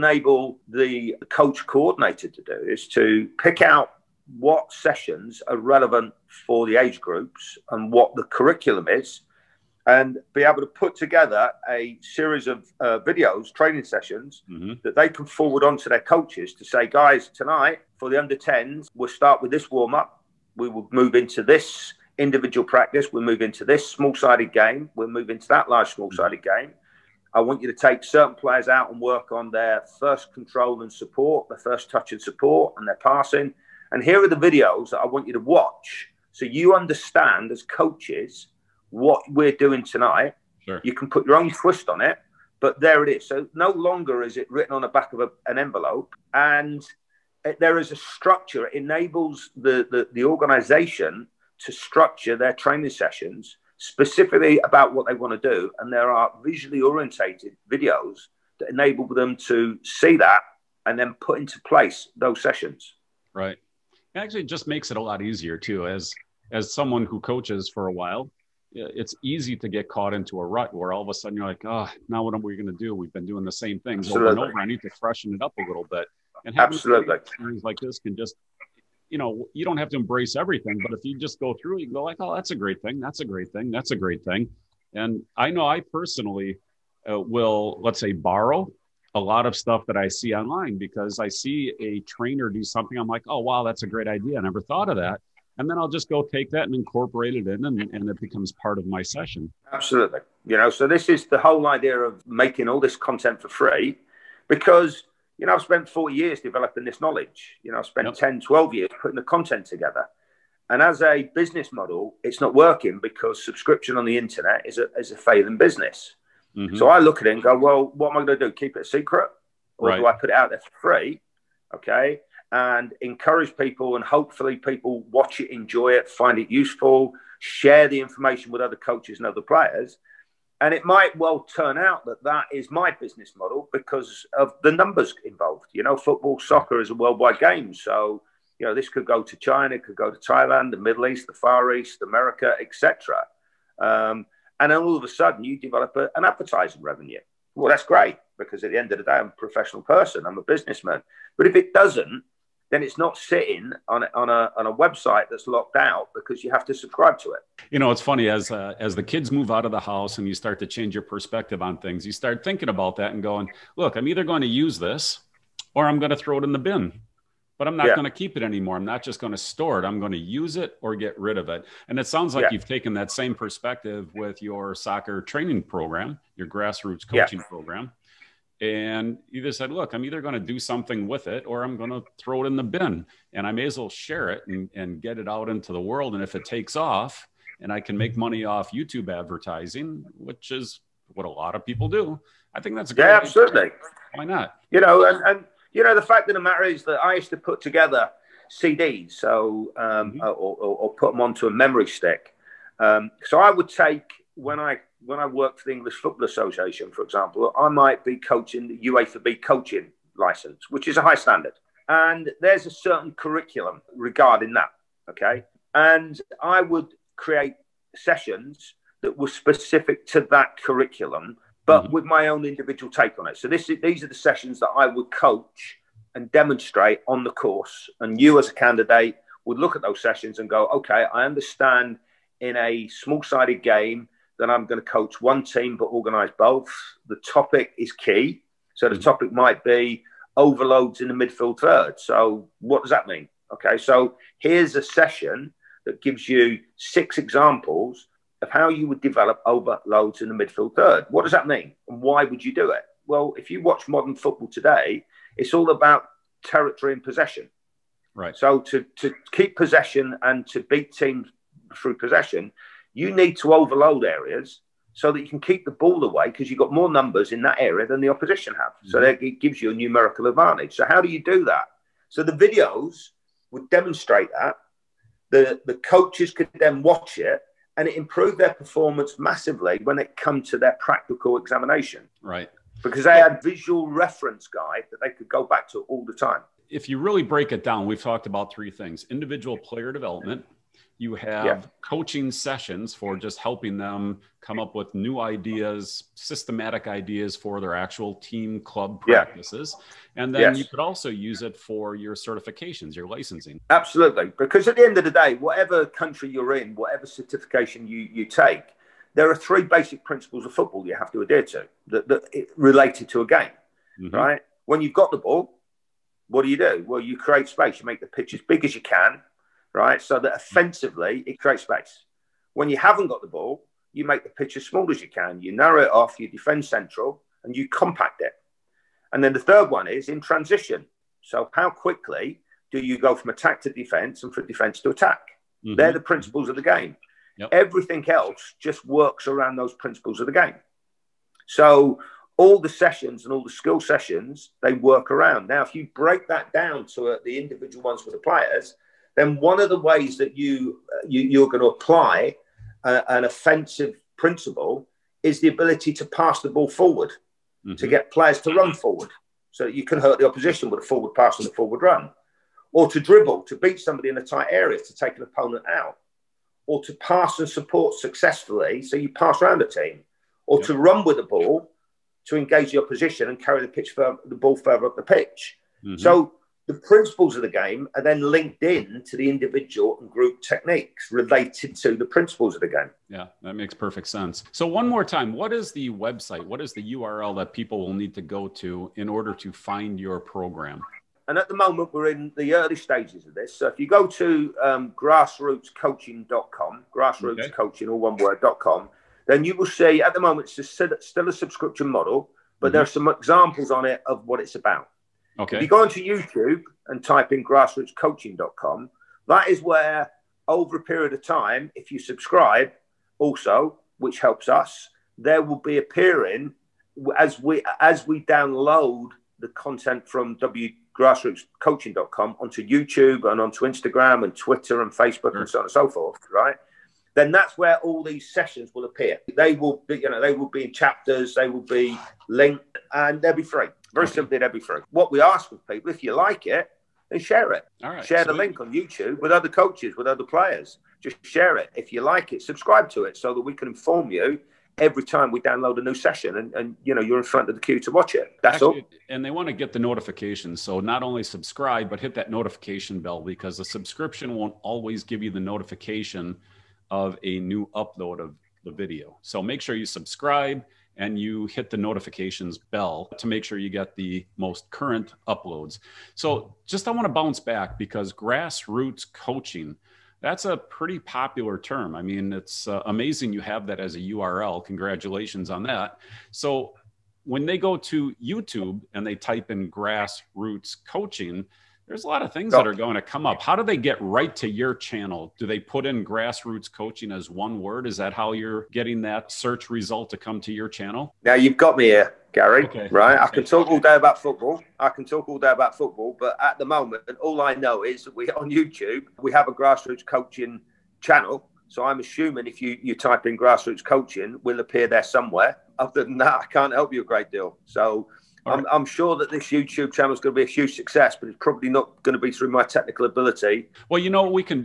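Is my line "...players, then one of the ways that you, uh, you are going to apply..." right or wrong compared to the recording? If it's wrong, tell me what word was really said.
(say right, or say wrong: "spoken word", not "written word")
right.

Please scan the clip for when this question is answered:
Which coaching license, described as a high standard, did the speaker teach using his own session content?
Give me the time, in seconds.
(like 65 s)
208 s.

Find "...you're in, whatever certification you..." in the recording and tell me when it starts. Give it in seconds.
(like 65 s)
306 s.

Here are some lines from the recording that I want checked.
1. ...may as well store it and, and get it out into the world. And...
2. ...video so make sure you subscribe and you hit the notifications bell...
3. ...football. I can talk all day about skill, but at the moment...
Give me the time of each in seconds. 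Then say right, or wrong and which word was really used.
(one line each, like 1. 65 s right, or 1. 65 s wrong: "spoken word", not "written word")
1. 183 s wrong: "share", not "store"
2. 458 s right
3. 494 s wrong: "football", not "skill".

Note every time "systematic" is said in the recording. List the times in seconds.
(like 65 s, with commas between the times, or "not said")
296 s.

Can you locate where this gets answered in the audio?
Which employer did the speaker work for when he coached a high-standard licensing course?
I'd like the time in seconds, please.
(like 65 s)
205 s.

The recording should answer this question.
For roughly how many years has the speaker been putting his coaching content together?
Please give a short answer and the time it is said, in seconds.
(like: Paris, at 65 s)
10 to 12, at 108 s.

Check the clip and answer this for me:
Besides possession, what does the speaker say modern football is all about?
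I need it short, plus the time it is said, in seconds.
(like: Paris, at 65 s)
Territory, at 256 s.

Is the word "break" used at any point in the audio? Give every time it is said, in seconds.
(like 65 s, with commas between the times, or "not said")
287 s, 345 s.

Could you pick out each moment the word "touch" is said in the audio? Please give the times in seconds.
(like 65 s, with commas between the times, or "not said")
31 s.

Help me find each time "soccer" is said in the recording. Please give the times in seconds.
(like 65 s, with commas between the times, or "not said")
136 s, 174 s.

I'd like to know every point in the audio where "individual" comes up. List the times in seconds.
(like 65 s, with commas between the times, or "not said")
22 s, 222 s, 289 s, 347 s, 379 s.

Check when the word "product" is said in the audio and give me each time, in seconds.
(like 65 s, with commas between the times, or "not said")
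not said.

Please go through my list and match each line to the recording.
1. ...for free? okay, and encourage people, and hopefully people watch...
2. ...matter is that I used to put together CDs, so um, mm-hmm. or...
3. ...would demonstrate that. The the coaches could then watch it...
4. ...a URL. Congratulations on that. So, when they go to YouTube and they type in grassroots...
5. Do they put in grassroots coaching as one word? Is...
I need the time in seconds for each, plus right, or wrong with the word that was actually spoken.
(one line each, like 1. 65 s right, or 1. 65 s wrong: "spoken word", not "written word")
1. 120 s right
2. 196 s right
3. 273 s right
4. 473 s right
5. 485 s right.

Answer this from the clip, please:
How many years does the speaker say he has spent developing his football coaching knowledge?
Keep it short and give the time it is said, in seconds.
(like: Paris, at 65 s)
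40, at 105 s.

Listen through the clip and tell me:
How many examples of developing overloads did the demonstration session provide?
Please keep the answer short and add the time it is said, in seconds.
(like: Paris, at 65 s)
6, at 246 s.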